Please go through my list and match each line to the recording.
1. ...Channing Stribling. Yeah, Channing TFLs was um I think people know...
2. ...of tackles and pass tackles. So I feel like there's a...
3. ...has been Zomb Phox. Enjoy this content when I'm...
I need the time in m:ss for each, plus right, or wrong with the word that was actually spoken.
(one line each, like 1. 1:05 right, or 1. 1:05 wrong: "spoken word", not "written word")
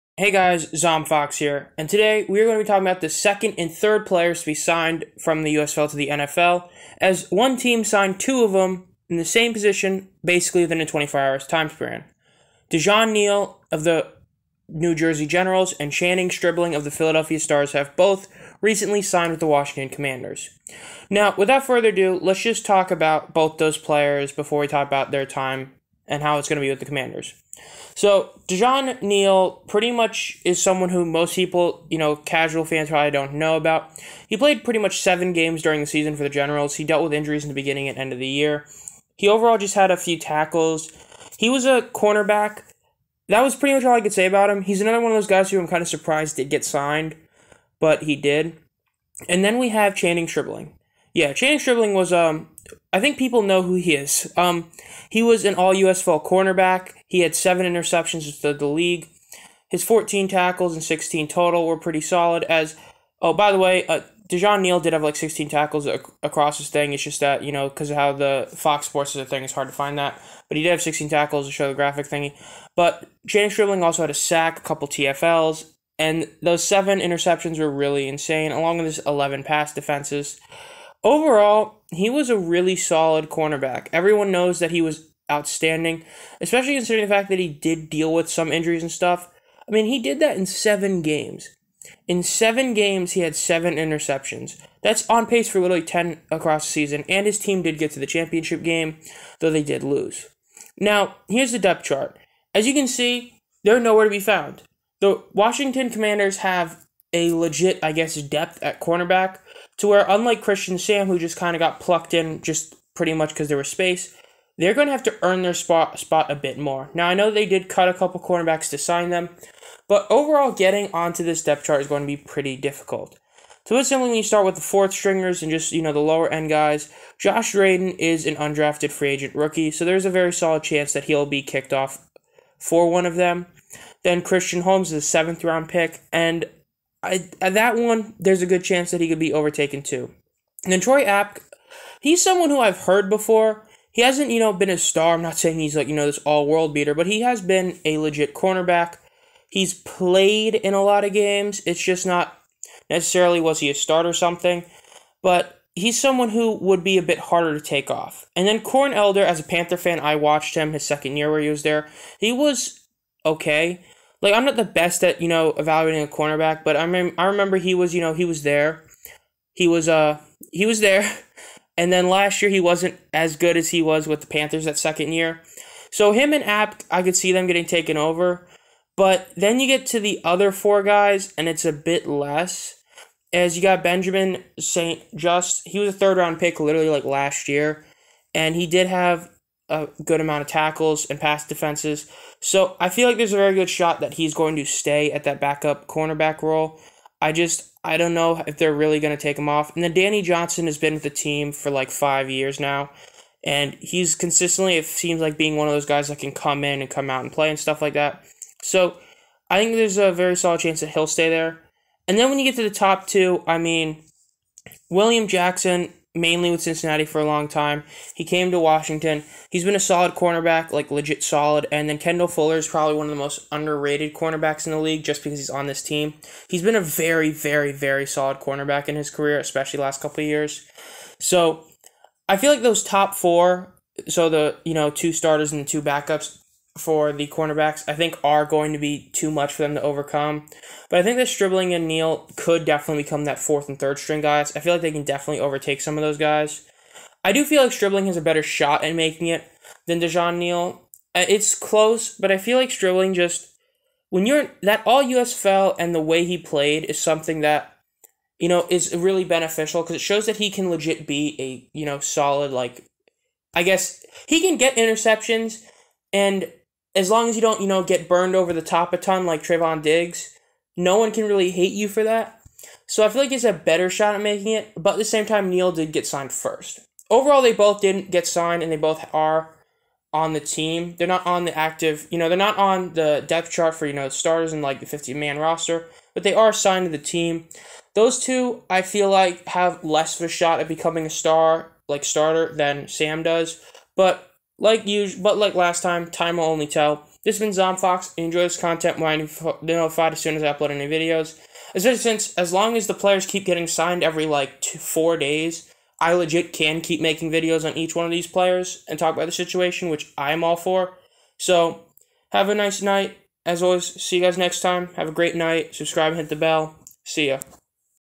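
1. 0:49 wrong: "Stribling", not "TFLs"
2. 3:10 wrong: "defenses", not "tackles"
3. 4:57 right.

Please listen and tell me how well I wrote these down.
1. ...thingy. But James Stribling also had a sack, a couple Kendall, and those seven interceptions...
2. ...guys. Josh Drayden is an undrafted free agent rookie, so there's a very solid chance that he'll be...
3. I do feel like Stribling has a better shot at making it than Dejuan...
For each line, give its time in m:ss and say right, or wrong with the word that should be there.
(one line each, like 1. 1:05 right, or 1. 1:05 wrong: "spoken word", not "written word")
1. 1:12 wrong: "TFLs", not "Kendall"
2. 2:06 right
3. 4:07 right.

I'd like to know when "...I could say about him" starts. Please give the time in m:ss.
0:43.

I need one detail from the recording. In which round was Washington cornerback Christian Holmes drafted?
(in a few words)
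Seventh round.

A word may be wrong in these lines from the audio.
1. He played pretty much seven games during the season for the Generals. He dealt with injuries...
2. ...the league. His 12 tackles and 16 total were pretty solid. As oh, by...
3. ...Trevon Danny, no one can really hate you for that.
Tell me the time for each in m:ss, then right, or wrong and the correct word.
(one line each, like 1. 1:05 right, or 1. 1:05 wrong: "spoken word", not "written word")
1. 0:34 right
2. 0:58 wrong: "14", not "12"
3. 4:29 wrong: "Diggs", not "Danny".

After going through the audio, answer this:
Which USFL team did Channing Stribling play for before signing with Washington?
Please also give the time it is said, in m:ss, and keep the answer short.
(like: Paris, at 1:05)
Philadelphia Stars, at 0:16.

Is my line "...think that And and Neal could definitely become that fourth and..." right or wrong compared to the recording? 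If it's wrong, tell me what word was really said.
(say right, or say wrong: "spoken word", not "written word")
wrong: "Stribling", not "And".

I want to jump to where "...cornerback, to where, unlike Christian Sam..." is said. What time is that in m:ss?
1:48.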